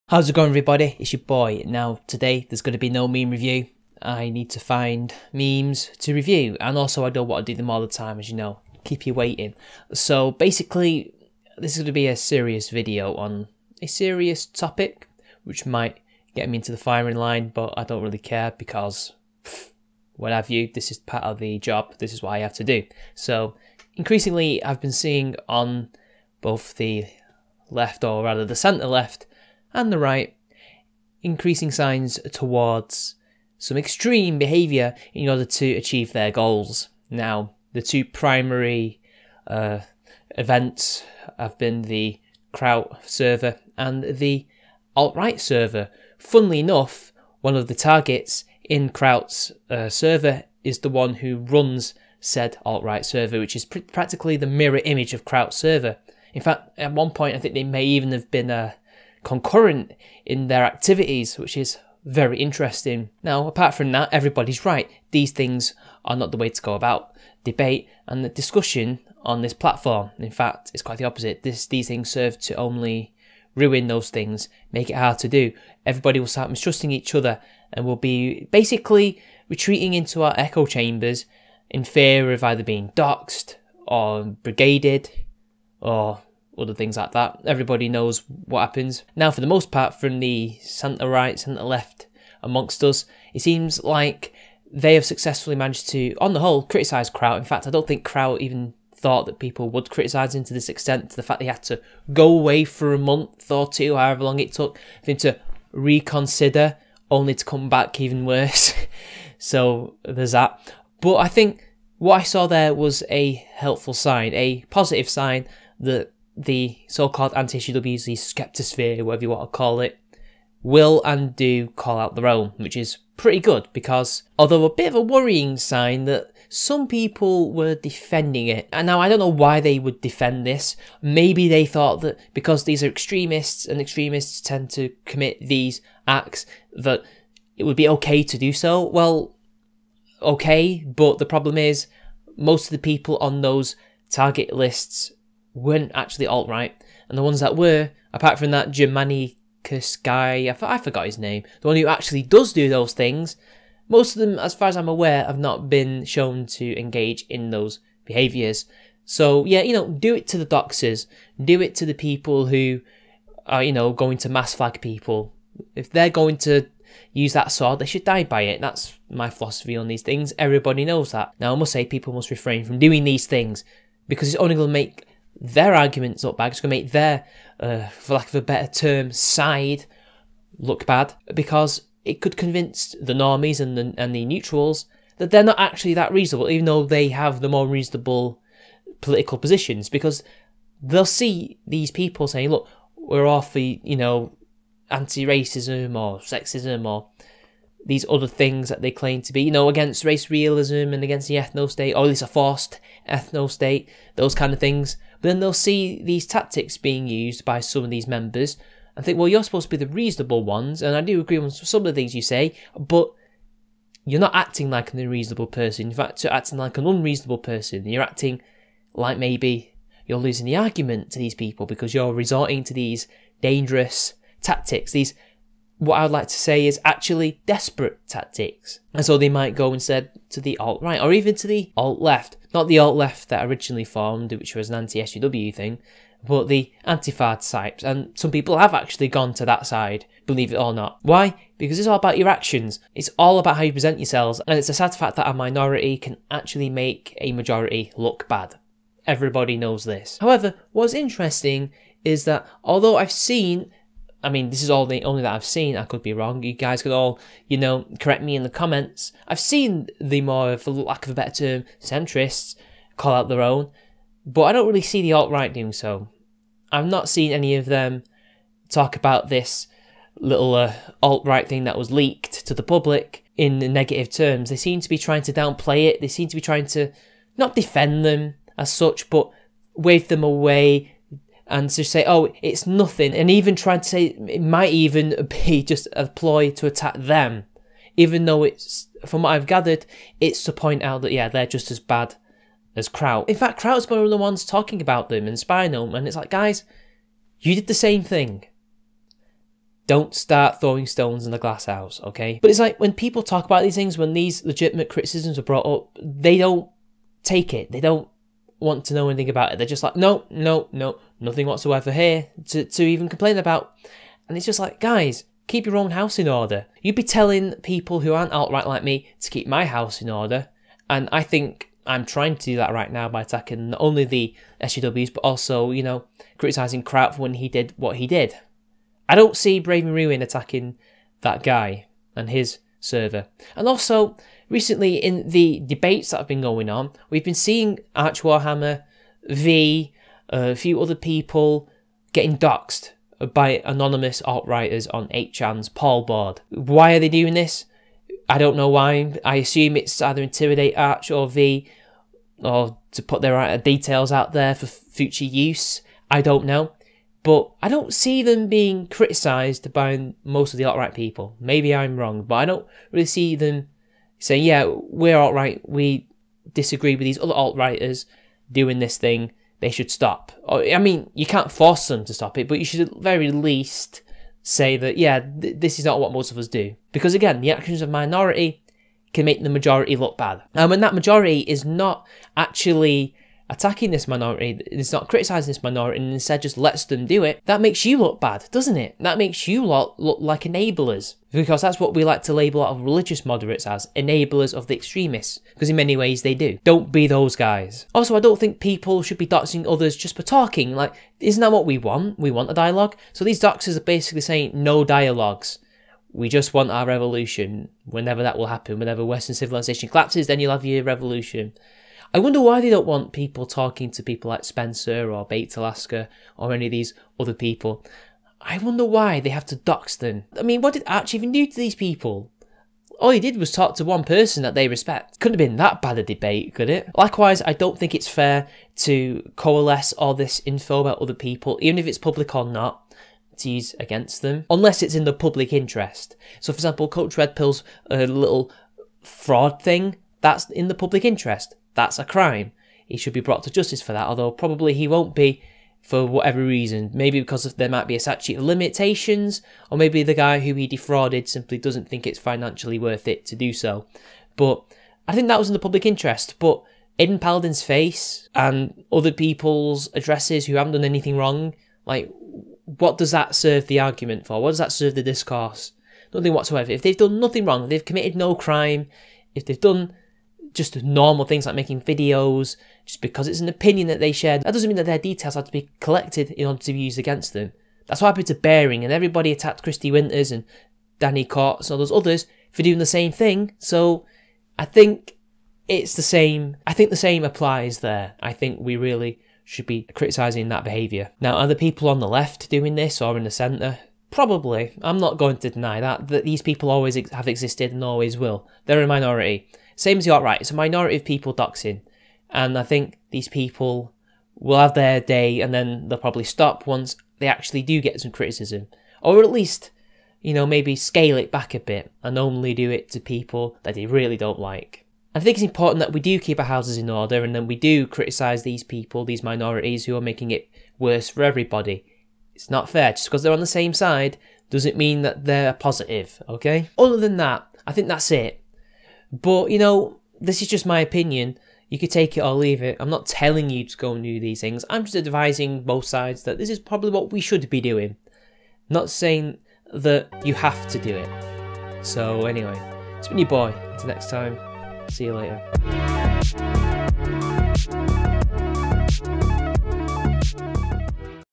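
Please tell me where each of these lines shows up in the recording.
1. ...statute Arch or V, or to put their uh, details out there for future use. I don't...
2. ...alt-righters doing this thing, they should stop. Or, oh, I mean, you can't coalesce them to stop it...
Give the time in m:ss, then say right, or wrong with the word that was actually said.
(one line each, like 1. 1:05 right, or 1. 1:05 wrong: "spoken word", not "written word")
1. 5:50 wrong: "intimidate", not "statute"
2. 6:07 wrong: "force", not "coalesce".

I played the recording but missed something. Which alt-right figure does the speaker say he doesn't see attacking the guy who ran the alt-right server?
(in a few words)
Braving Ruin.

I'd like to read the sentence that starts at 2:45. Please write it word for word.
If they're going to use that sword, they should die by it.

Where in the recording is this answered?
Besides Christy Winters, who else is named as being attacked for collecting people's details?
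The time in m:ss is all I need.
8:00.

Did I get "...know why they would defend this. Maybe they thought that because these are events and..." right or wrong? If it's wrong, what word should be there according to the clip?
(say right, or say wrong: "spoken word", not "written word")
wrong: "extremists", not "events".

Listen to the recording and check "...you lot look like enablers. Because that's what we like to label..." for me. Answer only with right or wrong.
right.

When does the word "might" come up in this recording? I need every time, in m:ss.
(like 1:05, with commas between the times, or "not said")
0:15, 3:49, 4:44, 7:27.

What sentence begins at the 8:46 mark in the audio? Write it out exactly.
Other than that, I think that's it.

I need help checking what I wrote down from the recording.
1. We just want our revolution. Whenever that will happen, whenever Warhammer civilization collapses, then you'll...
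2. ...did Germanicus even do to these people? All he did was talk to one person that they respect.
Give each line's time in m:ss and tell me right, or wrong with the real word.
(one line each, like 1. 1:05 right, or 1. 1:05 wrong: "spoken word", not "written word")
1. 6:46 wrong: "Western", not "Warhammer"
2. 7:00 wrong: "Arch", not "Germanicus".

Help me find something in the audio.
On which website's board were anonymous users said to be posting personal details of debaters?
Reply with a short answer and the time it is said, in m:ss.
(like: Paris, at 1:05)
8chan, at 5:45.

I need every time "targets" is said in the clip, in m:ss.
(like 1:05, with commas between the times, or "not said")
0:47, 2:24.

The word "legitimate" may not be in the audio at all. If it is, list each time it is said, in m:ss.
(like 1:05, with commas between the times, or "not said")
5:04.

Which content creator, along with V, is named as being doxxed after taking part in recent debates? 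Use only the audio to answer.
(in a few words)
Arch Warhammer.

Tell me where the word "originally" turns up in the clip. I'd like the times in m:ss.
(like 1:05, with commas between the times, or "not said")
3:53.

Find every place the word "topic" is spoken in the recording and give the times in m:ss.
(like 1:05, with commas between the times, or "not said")
0:14.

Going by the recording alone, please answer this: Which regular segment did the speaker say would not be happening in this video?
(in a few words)
Meme review.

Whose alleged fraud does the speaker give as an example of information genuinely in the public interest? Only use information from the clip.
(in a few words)
Coach Red Pill.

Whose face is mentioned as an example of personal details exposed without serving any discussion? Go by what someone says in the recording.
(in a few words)
Aydin Paladin.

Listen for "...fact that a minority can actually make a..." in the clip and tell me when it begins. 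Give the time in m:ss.
4:04.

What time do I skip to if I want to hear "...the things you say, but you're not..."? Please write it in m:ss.
3:31.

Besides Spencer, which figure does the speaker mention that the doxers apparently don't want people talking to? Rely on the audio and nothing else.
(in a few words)
Baked Alaska.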